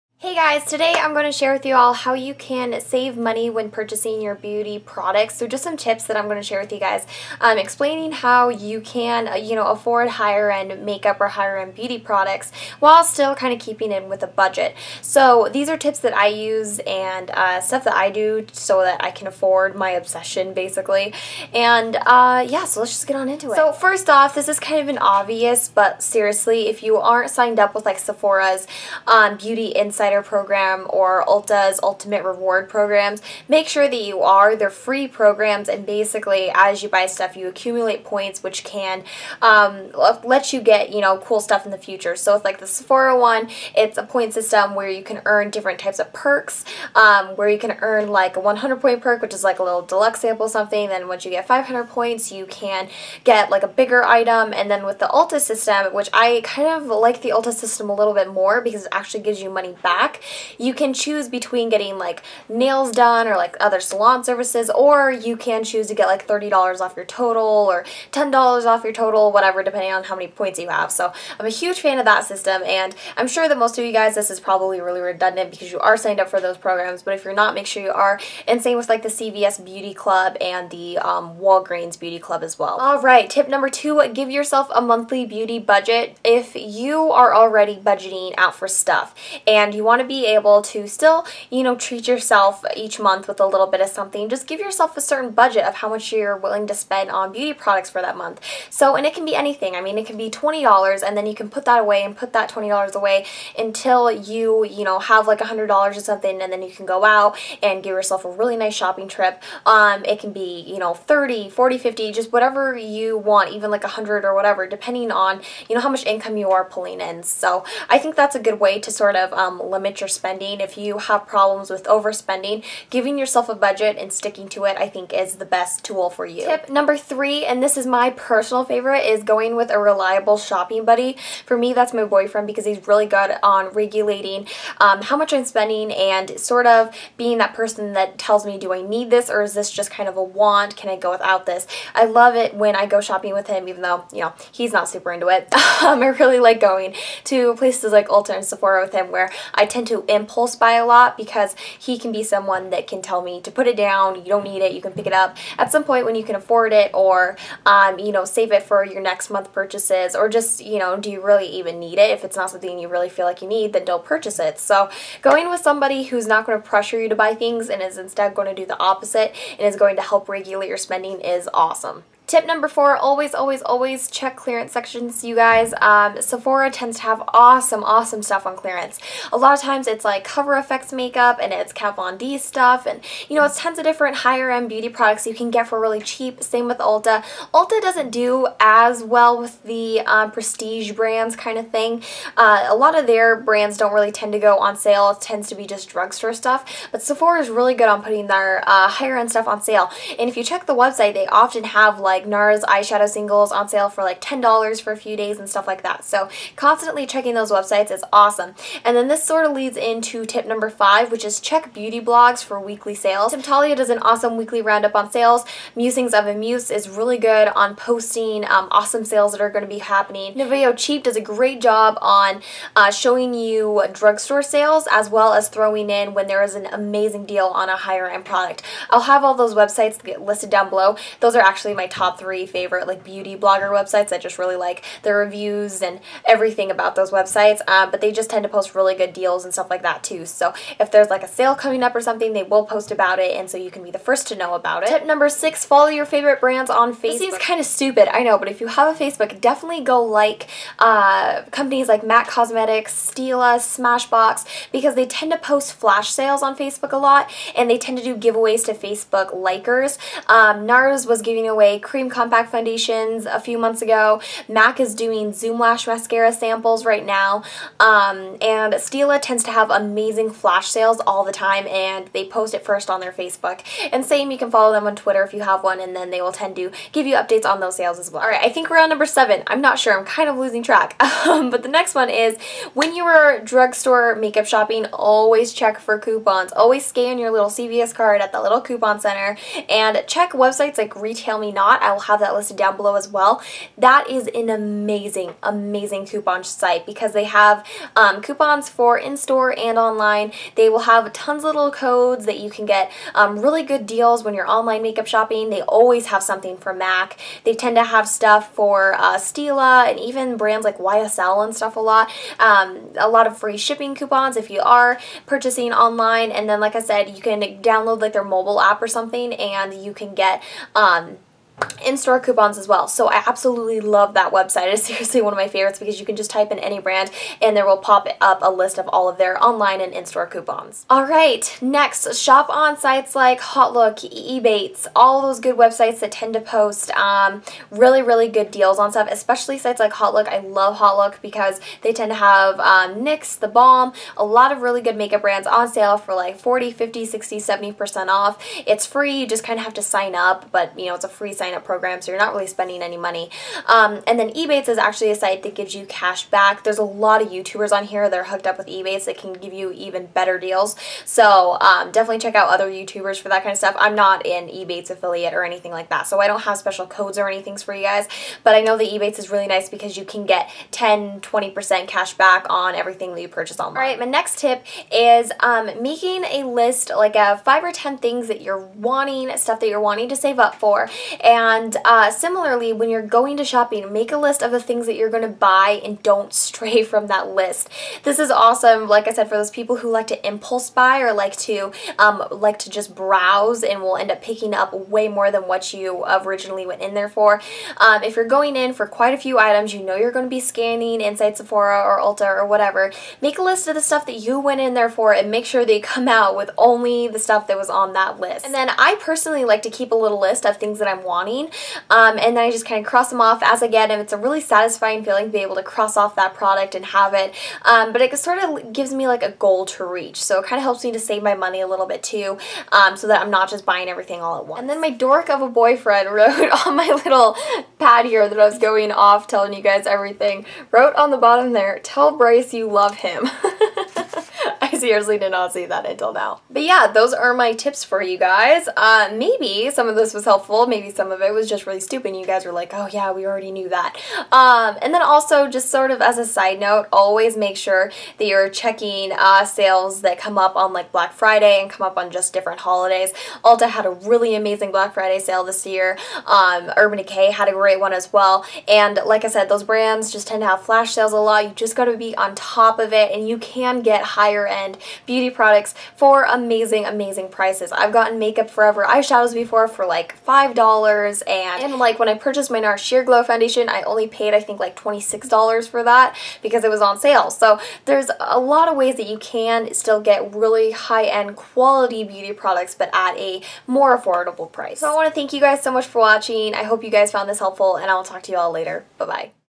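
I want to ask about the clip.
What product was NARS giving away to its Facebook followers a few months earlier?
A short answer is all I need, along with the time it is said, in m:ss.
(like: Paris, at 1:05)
Cream Compact Foundations, at 4:21.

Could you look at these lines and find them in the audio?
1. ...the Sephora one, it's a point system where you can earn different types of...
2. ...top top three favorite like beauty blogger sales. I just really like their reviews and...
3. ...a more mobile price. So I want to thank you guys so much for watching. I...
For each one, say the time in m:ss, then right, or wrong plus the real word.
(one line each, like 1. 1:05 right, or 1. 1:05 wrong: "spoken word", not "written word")
1. 0:42 right
2. 3:51 wrong: "websites", not "sales"
3. 8:03 wrong: "affordable", not "mobile".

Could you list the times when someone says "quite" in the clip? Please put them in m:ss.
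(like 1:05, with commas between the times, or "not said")
6:38.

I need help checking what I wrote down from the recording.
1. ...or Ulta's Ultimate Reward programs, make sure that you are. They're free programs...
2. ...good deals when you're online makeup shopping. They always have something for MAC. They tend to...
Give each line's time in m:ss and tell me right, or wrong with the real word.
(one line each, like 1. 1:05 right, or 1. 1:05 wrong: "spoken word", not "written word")
1. 0:30 right
2. 5:03 right.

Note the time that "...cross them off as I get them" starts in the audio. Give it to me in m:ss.
6:52.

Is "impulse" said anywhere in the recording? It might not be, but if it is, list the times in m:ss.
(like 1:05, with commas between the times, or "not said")
2:30, 6:30.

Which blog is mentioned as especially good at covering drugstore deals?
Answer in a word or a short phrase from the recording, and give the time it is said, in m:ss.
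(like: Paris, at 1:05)
Nouveau Cheap, at 3:40.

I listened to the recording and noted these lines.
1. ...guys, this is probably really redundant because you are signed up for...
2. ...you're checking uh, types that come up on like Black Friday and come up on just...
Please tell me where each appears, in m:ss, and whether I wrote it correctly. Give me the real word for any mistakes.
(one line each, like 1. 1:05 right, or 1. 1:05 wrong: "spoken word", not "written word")
1. 1:13 right
2. 7:28 wrong: "sales", not "types".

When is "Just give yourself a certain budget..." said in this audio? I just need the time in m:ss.
1:34.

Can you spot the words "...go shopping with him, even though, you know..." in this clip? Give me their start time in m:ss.
2:22.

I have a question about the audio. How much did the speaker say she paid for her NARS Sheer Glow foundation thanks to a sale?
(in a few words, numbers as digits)
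$26.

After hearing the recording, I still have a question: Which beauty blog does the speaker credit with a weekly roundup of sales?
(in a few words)
Temptalia.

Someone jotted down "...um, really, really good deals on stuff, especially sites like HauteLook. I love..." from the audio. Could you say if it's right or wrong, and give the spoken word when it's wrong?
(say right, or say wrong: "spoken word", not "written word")
right.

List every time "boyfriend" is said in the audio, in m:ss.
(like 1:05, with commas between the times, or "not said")
2:12, 7:05.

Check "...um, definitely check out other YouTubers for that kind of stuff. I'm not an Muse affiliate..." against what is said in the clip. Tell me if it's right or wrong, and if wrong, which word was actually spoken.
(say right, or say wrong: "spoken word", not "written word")
wrong: "Ebates", not "Muse".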